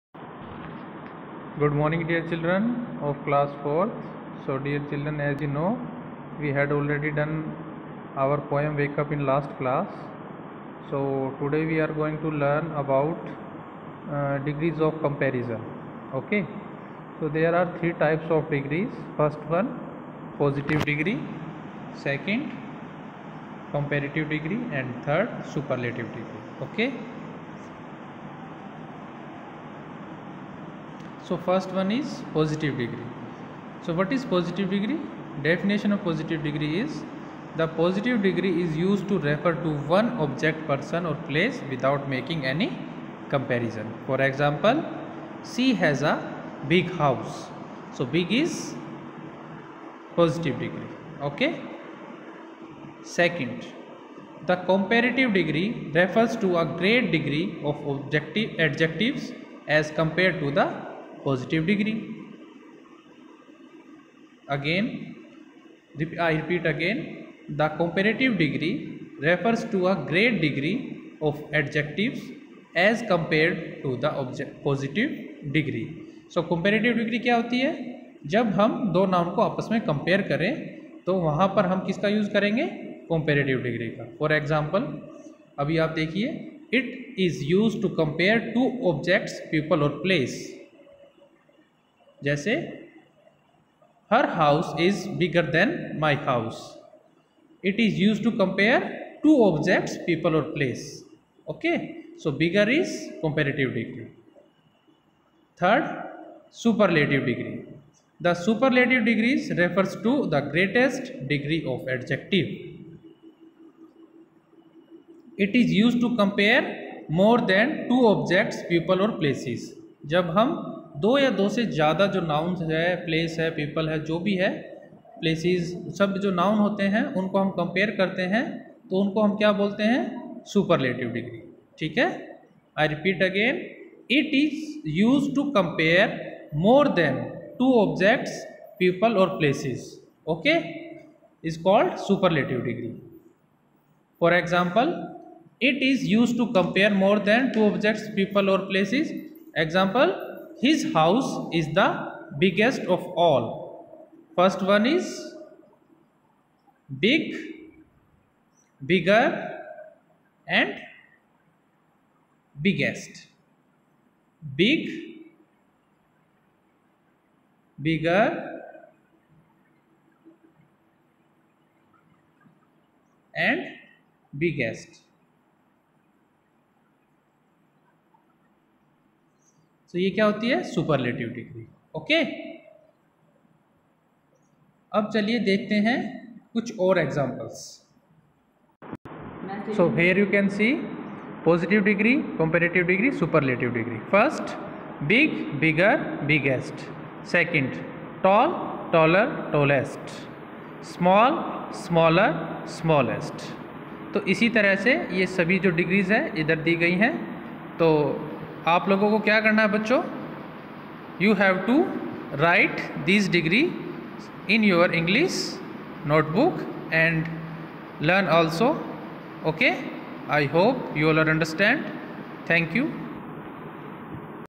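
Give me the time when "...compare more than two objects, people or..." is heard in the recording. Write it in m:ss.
1:56.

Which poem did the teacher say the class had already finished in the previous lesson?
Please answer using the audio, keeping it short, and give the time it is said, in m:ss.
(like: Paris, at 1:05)
Wake Up, at 0:08.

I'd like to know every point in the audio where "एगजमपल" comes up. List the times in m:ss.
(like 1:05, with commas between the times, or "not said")
1:24, 2:24.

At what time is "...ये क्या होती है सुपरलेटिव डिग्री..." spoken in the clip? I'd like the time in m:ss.
2:59.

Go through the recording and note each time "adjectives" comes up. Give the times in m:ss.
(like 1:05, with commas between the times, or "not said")
0:58, 1:11, 1:51.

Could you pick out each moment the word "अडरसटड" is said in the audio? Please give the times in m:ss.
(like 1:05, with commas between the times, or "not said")
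3:41.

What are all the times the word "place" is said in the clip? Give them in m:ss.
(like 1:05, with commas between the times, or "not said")
0:41, 1:40, 1:59.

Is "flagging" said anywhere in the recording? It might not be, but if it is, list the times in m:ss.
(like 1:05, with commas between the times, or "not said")
not said.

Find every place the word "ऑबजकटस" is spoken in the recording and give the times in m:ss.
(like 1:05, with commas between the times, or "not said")
1:28, 2:17, 2:27.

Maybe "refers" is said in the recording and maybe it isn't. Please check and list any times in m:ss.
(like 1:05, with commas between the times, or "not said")
0:39, 0:55, 1:09, 1:49.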